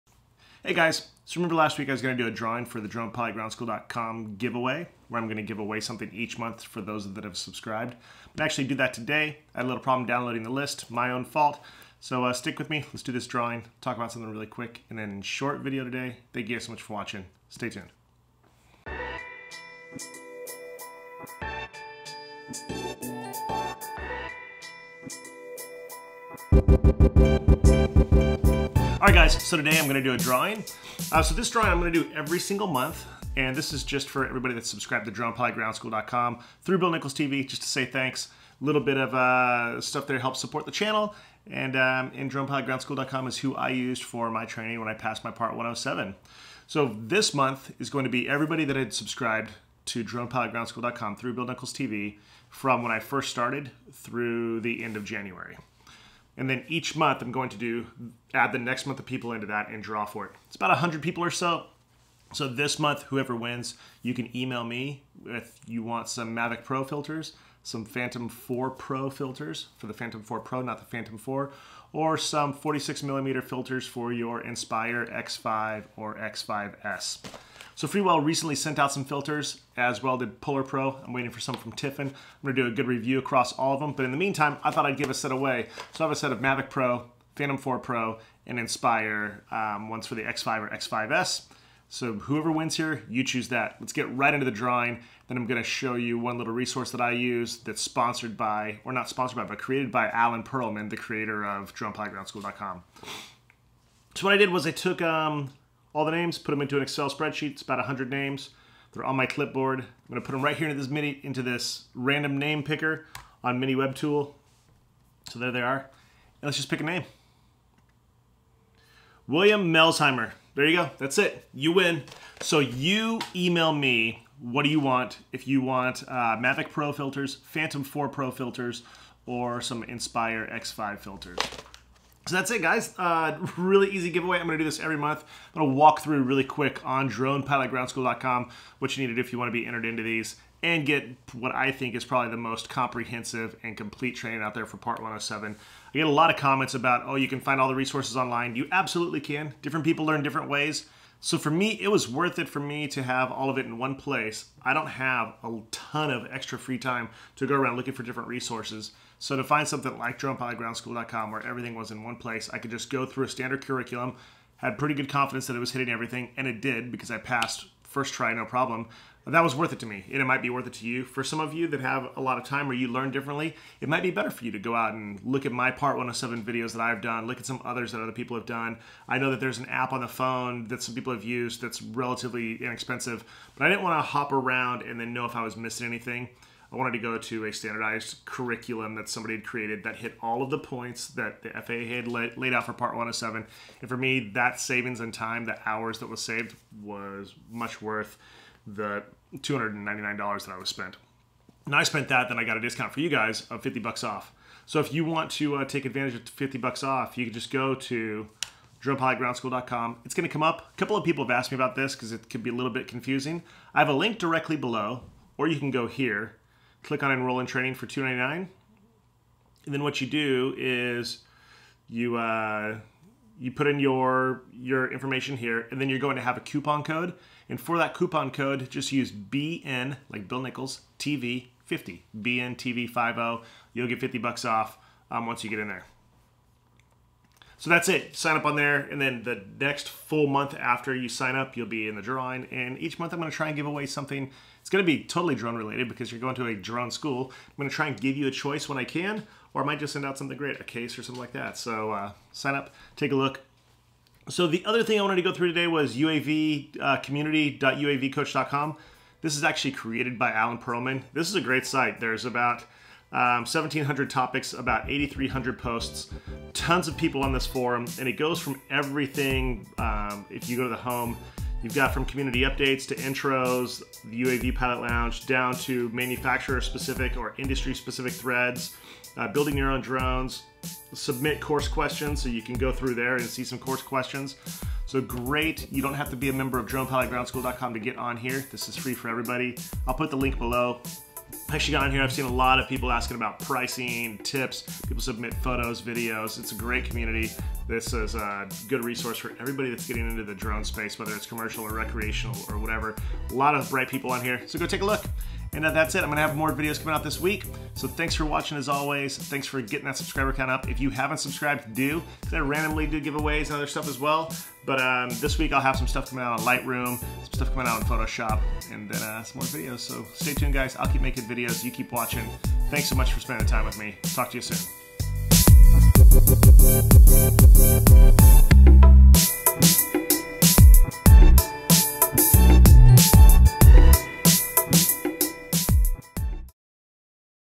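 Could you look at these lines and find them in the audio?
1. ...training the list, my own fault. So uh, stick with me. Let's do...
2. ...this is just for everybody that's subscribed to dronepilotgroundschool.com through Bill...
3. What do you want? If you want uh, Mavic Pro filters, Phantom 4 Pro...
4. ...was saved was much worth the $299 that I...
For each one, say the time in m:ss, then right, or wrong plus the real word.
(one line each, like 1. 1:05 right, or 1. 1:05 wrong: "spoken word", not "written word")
1. 0:10 wrong: "downloading", not "training"
2. 0:33 right
3. 2:04 right
4. 3:16 right.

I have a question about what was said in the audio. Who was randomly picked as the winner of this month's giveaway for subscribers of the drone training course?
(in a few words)
William Melsheimer.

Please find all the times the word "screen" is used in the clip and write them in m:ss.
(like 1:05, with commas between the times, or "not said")
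not said.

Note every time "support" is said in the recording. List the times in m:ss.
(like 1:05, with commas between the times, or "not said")
0:40.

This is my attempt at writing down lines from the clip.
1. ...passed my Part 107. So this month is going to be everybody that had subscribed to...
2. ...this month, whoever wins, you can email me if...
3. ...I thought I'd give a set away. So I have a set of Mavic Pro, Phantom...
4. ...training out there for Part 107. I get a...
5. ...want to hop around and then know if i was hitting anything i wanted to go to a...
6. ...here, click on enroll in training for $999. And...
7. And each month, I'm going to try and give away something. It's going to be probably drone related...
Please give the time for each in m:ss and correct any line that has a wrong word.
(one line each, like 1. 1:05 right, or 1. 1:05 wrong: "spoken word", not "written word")
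1. 0:44 right
2. 1:02 right
3. 1:24 right
4. 2:24 right
5. 3:03 wrong: "missing", not "hitting"
6. 3:35 wrong: "299", not "999"
7. 4:02 wrong: "totally", not "probably".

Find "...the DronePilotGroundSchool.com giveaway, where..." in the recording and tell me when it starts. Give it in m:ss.
0:02.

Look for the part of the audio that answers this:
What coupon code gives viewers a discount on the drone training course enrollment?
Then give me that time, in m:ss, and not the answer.
3:52.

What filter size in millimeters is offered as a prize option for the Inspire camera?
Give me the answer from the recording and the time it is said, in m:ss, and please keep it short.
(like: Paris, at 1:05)
46, at 1:12.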